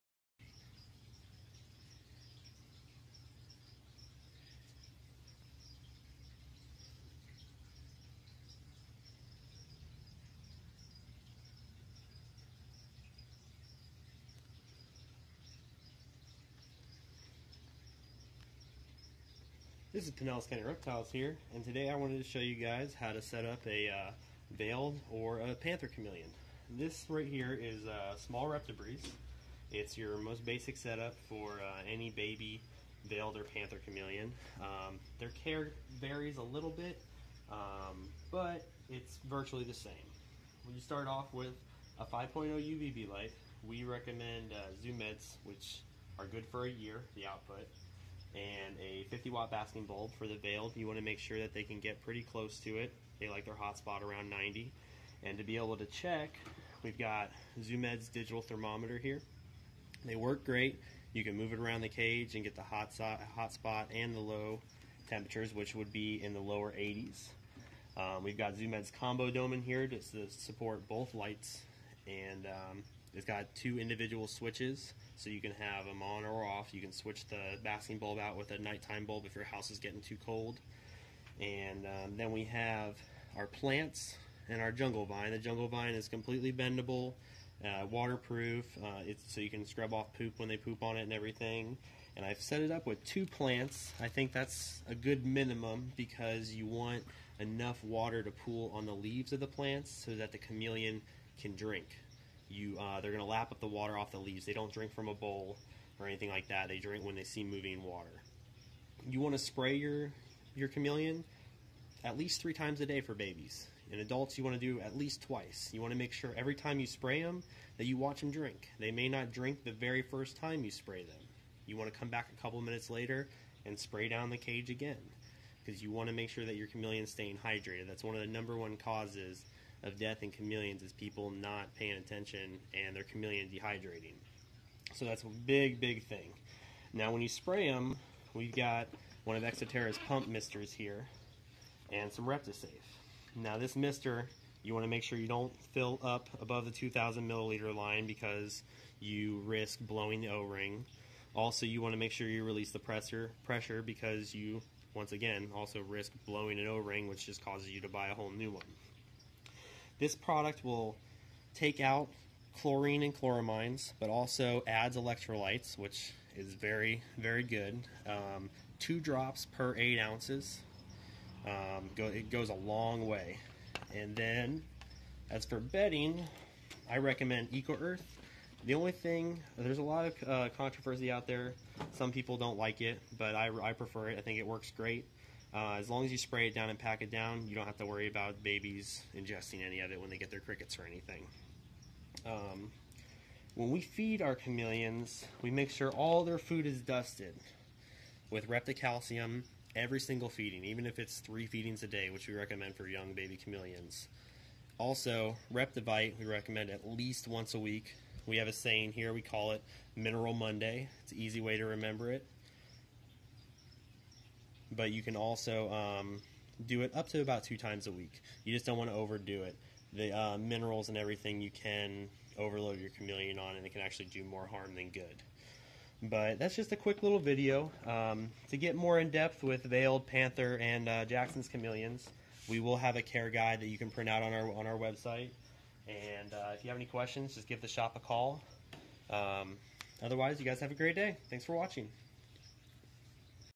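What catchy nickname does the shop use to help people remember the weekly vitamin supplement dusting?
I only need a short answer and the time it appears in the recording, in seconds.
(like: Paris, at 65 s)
Mineral Monday, at 209 s.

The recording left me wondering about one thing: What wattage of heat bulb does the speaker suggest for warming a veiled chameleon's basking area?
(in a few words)
50 watt.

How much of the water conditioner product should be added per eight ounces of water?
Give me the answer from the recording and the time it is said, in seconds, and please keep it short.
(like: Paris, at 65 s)
2 drops, at 168 s.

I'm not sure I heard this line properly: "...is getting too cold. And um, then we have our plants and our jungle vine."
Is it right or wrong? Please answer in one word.
right.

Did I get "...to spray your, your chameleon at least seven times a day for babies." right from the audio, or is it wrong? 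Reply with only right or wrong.
wrong.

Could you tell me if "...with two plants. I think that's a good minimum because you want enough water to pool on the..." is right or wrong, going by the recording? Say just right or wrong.
right.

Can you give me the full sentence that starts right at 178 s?
The only thing, there's a lot of uh, controversy out there.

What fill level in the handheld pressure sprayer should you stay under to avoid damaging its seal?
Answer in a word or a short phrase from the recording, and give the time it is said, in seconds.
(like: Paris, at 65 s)
2,000 milliliters, at 146 s.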